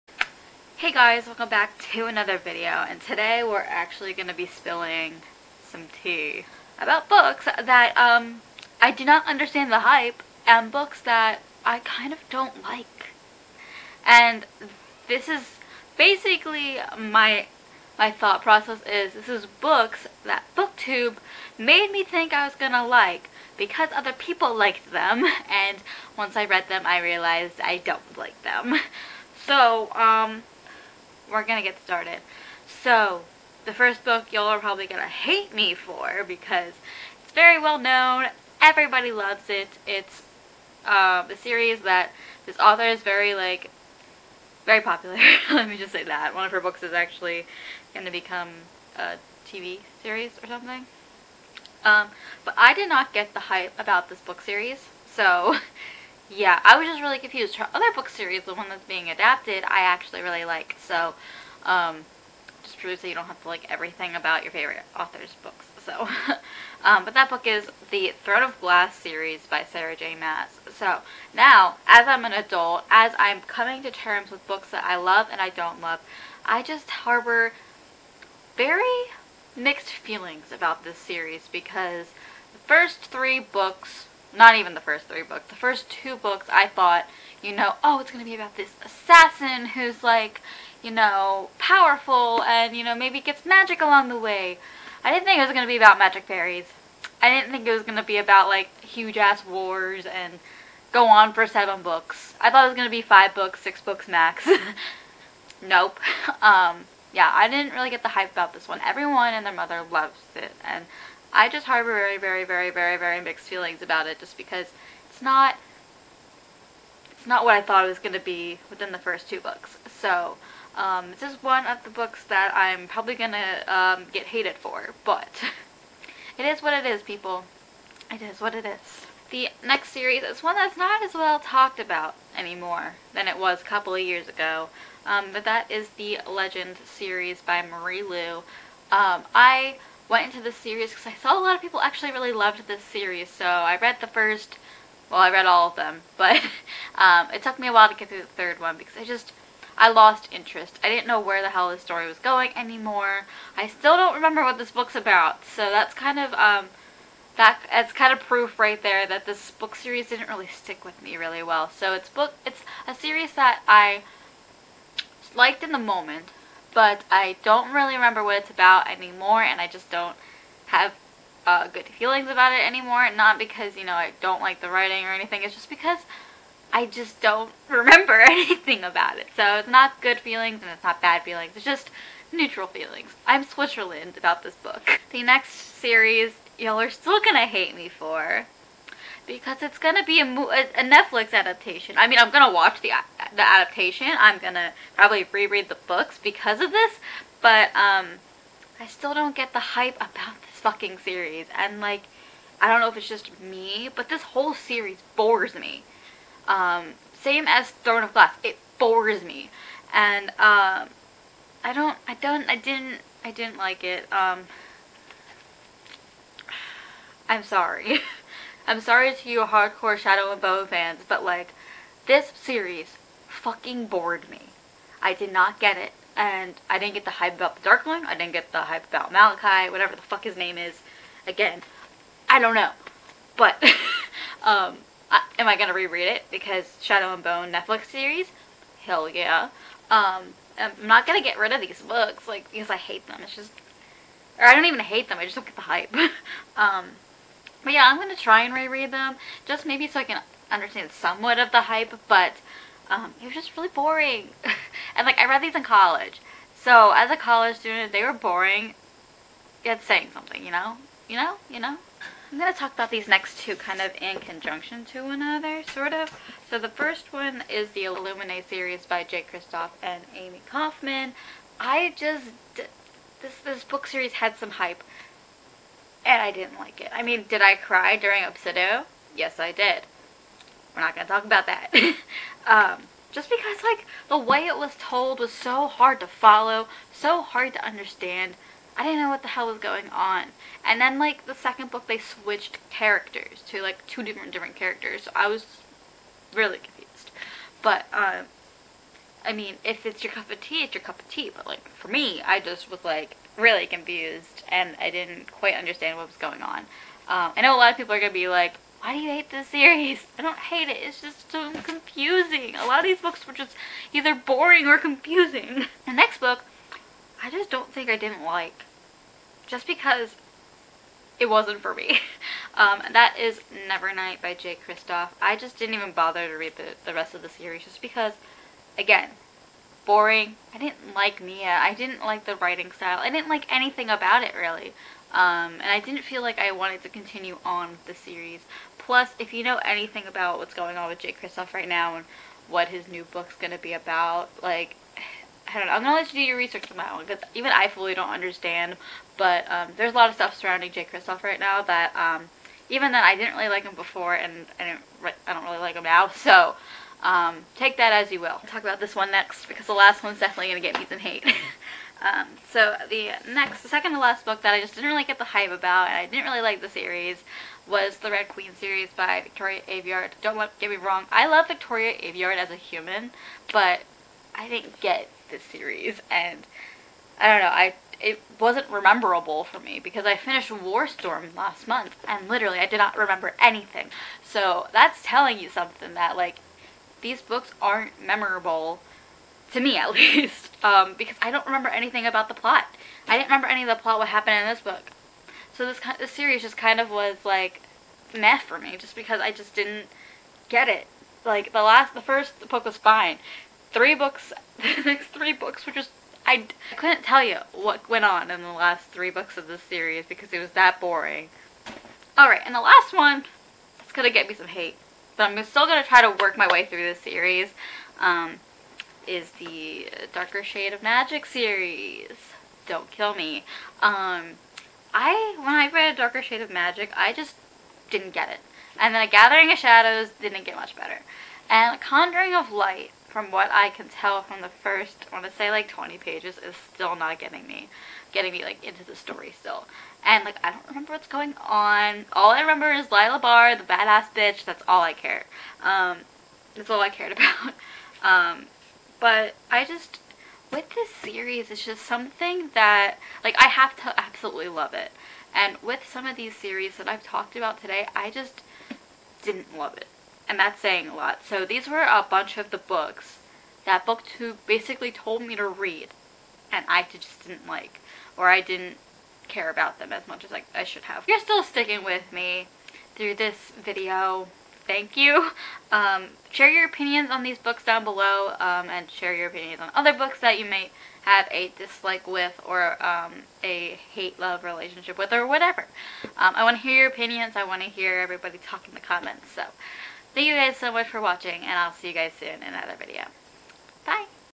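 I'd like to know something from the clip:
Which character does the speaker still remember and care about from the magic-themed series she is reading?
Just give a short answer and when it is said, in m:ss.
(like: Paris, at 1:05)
Lila Bard, at 7:22.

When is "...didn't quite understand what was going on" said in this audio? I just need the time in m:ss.
5:04.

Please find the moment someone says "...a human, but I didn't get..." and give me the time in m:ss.
6:12.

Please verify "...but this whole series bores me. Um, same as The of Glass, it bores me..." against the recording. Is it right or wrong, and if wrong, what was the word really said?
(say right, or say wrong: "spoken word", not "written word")
wrong: "Throne", not "The".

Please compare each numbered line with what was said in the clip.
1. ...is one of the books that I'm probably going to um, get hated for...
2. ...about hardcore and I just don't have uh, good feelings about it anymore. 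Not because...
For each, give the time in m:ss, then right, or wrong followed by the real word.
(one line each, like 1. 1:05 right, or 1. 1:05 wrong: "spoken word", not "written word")
1. 2:01 right
2. 2:48 wrong: "anymore", not "hardcore".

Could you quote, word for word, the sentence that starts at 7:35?
And with some of these series that I've talked about today, I just didn't love it and that's saying a lot.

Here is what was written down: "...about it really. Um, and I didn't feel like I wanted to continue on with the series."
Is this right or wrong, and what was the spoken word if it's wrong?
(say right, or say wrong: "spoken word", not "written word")
right.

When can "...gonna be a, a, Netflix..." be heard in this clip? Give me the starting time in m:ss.
3:09.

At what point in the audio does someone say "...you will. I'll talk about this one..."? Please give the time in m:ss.
5:58.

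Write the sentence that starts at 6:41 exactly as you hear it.
Like the last, the first book was fine.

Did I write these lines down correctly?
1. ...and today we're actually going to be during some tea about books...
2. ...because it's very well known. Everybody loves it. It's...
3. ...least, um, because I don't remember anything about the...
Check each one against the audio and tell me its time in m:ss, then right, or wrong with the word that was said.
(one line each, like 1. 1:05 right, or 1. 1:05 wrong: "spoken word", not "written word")
1. 0:02 wrong: "spilling", not "during"
2. 0:36 right
3. 6:29 right.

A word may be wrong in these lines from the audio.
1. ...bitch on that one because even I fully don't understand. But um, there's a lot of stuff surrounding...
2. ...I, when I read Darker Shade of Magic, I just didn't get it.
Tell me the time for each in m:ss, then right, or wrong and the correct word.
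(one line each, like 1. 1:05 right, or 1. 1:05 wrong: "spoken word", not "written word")
1. 5:46 wrong: "research", not "bitch"
2. 7:04 right.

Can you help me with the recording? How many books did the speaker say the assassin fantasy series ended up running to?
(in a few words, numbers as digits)
7.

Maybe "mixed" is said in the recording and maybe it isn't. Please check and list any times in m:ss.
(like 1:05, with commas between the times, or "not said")
1:19, 1:53.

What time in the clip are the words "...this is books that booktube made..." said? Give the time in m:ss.
0:19.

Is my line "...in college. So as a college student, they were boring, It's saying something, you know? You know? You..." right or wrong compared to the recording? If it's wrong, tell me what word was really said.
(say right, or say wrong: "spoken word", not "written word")
right.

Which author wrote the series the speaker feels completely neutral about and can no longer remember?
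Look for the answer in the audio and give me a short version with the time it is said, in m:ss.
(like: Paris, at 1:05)
Marie Lu, at 2:17.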